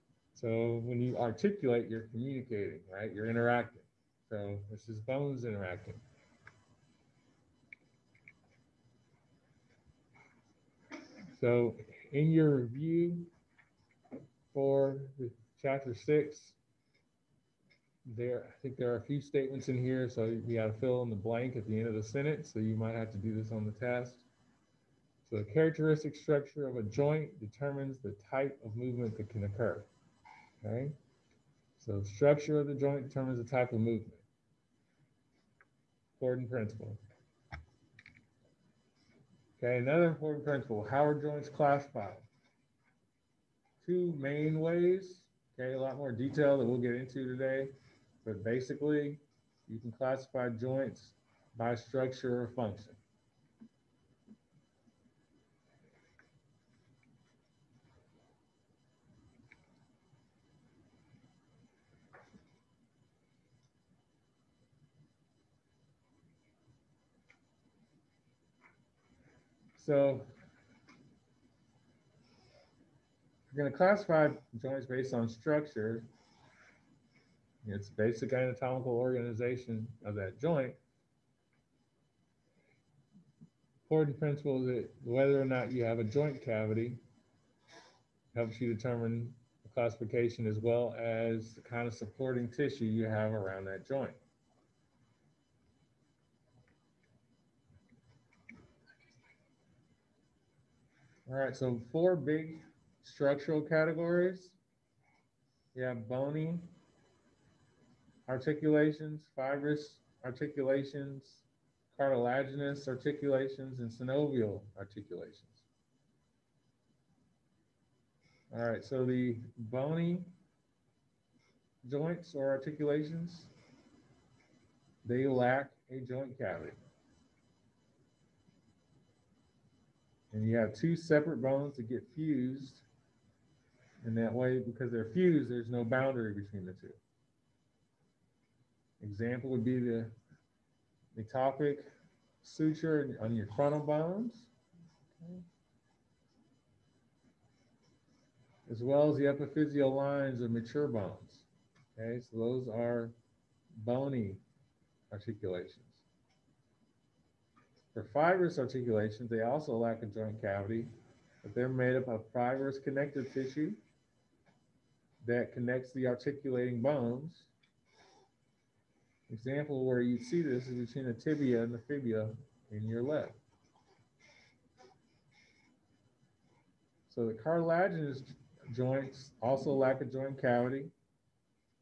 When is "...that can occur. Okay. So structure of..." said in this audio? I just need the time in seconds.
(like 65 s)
29 s.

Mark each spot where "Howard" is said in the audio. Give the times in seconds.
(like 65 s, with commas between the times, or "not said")
40 s.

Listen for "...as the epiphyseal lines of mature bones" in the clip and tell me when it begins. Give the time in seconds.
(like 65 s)
149 s.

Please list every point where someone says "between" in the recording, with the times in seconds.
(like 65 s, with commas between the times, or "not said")
136 s, 170 s.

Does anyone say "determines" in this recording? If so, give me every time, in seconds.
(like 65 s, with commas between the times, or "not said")
27 s, 33 s, 88 s.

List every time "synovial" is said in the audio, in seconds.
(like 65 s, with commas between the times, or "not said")
113 s.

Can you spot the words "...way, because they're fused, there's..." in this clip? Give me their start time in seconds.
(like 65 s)
134 s.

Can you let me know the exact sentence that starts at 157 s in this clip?
For fibrous articulations, they also lack a joint cavity, but they're made up of fibrous connective tissue that connects the articulating bones.